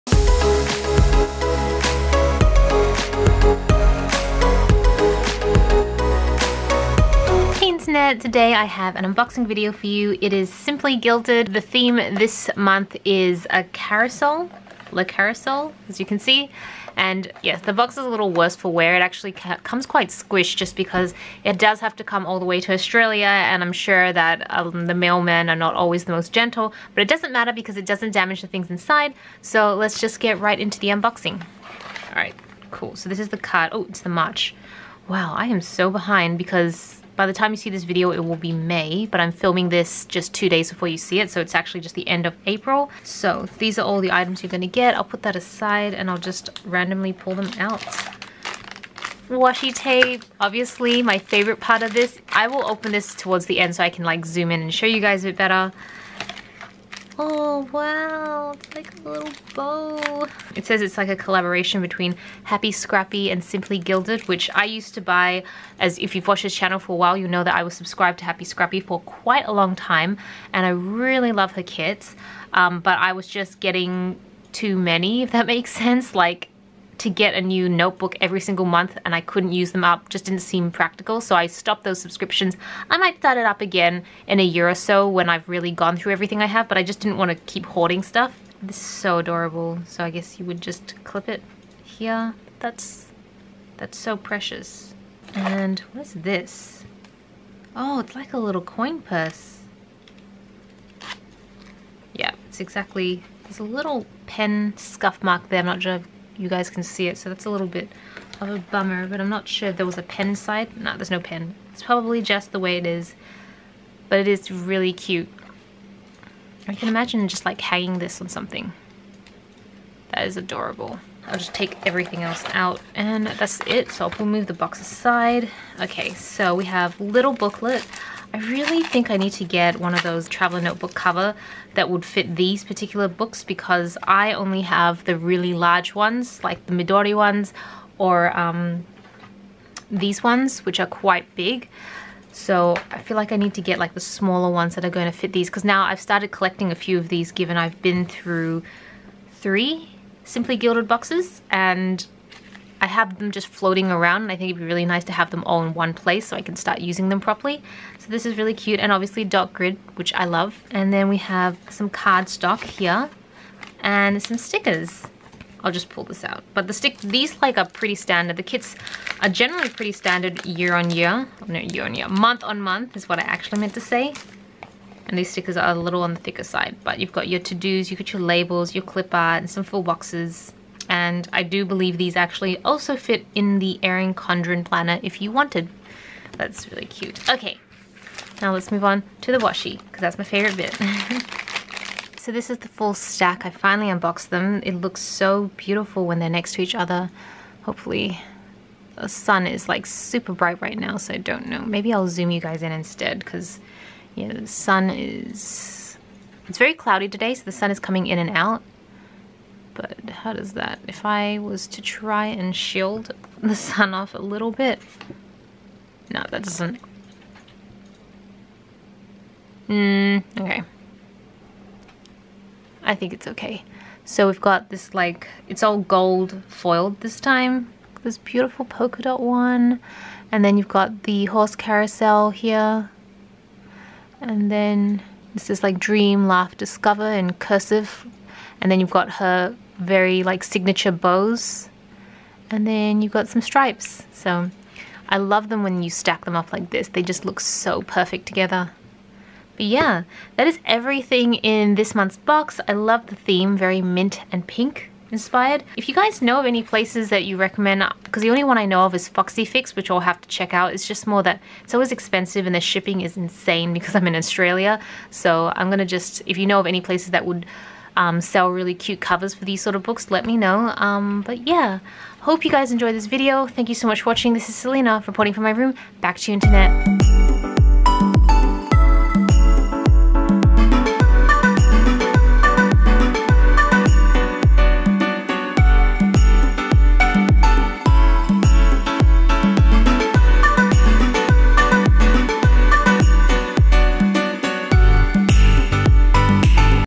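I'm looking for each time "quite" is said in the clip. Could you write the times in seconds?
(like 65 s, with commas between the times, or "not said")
19 s, 69 s, 140 s.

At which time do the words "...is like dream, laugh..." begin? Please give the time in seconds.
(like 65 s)
235 s.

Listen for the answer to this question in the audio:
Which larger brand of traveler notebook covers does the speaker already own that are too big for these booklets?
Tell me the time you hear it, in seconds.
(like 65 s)
136 s.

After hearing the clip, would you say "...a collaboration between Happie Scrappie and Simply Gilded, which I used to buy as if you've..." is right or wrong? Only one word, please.
right.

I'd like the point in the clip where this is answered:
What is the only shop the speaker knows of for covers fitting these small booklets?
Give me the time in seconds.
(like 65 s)
259 s.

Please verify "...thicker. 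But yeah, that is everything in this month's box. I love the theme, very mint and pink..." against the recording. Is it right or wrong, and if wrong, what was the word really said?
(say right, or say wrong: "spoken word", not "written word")
wrong: "together", not "thicker".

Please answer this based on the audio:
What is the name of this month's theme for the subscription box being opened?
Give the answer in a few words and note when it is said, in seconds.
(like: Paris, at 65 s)
Le Carousel, at 14 s.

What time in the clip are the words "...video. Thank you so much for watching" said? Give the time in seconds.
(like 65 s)
273 s.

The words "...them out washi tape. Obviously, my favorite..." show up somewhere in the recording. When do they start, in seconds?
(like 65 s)
47 s.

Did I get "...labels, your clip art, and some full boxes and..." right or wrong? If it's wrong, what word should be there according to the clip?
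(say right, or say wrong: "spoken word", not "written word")
right.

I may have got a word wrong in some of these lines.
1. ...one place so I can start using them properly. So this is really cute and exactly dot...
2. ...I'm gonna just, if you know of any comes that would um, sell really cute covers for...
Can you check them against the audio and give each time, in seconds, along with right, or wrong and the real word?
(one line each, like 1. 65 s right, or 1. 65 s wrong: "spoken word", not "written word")
1. 155 s wrong: "obviously", not "exactly"
2. 265 s wrong: "places", not "comes".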